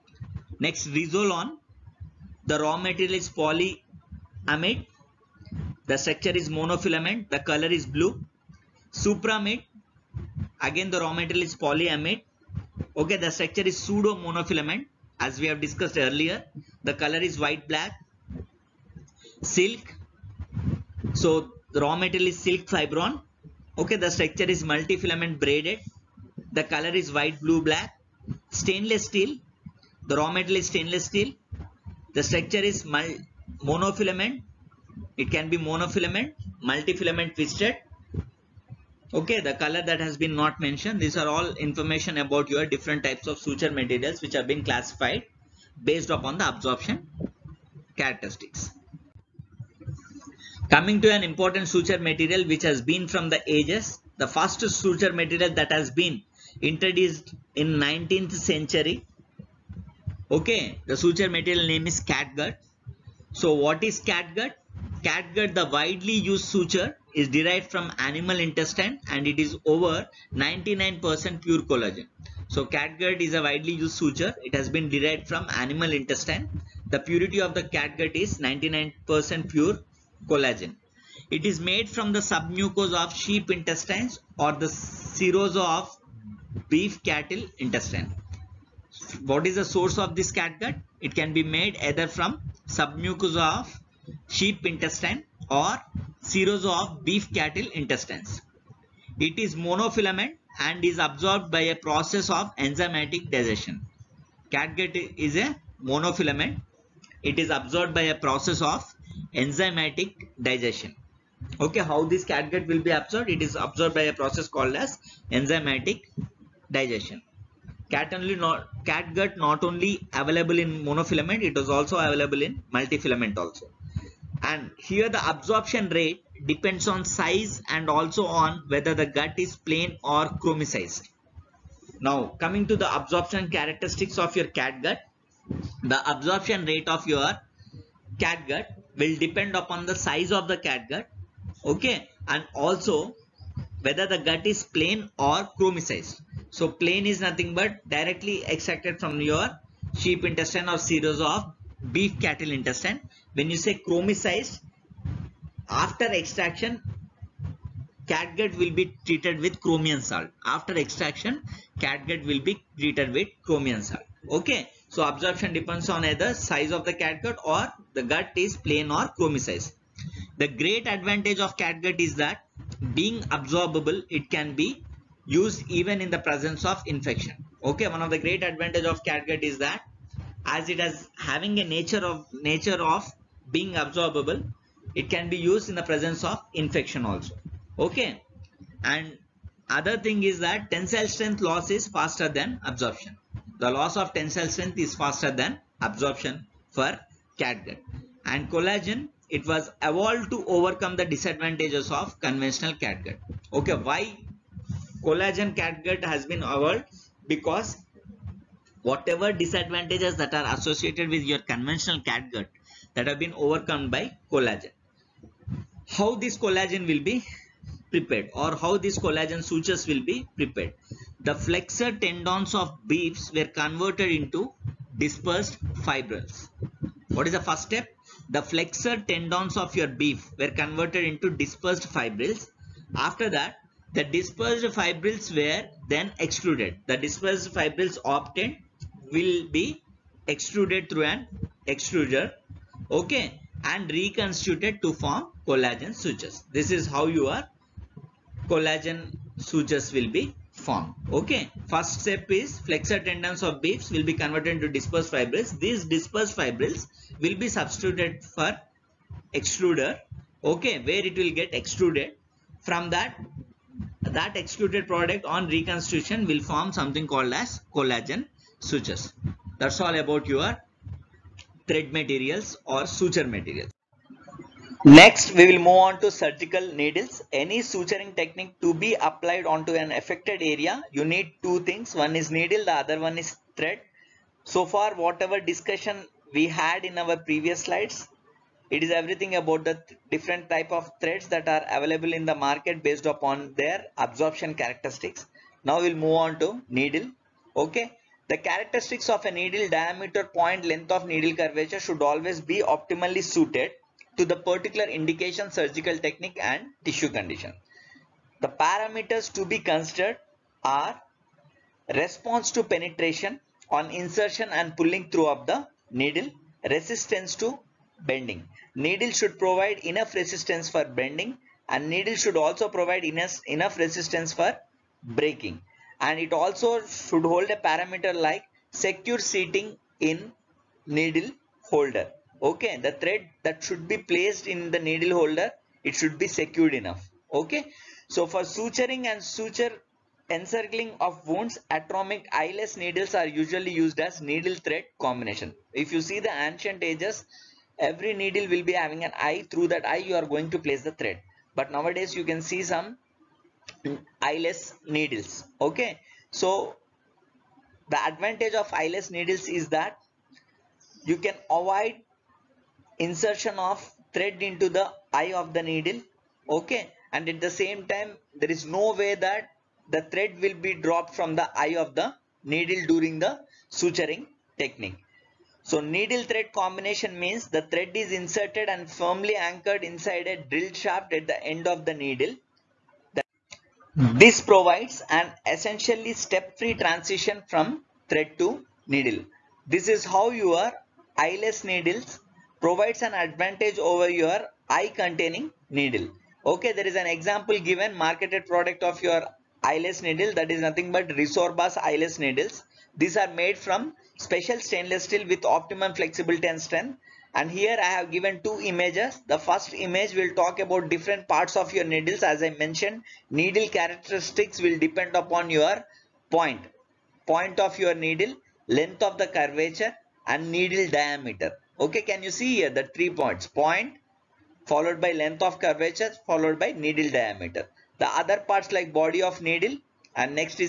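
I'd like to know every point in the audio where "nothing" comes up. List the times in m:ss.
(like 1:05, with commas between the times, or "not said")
2:27, 6:40.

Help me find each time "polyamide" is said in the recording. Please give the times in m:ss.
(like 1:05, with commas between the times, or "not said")
0:03, 0:11.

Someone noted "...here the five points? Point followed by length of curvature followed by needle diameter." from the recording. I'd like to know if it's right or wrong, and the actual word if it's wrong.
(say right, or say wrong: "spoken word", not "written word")
wrong: "three", not "five".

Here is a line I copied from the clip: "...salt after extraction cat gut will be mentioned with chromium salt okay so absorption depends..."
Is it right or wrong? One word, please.
wrong.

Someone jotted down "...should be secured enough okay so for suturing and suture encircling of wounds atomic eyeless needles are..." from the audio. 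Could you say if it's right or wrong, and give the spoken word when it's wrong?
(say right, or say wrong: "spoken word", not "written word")
right.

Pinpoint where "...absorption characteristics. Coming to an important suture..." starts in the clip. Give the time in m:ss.
0:46.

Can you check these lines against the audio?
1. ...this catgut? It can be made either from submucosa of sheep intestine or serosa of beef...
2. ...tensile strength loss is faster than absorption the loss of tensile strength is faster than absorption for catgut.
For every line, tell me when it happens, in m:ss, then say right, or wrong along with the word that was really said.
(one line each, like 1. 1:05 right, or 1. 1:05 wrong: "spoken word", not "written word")
1. 1:30 right
2. 3:10 right.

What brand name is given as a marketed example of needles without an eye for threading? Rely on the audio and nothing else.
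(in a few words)
Resorbas.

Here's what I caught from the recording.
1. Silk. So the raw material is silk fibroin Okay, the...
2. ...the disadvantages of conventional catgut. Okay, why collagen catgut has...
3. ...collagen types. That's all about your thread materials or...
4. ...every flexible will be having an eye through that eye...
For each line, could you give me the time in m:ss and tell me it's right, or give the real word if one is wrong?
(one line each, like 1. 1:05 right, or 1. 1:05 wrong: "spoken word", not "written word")
1. 0:19 right
2. 3:20 right
3. 4:27 wrong: "sutures", not "types"
4. 5:47 wrong: "needle", not "flexible".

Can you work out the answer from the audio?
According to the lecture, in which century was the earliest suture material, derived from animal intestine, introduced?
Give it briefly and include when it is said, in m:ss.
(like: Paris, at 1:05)
19th century, at 0:57.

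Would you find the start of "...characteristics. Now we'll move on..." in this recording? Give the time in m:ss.
4:54.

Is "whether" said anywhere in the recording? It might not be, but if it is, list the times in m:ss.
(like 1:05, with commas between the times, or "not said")
2:08, 2:23.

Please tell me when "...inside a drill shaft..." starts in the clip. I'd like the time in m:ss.
6:19.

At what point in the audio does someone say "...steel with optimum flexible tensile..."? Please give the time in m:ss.
6:45.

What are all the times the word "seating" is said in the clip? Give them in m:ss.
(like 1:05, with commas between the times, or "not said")
5:29.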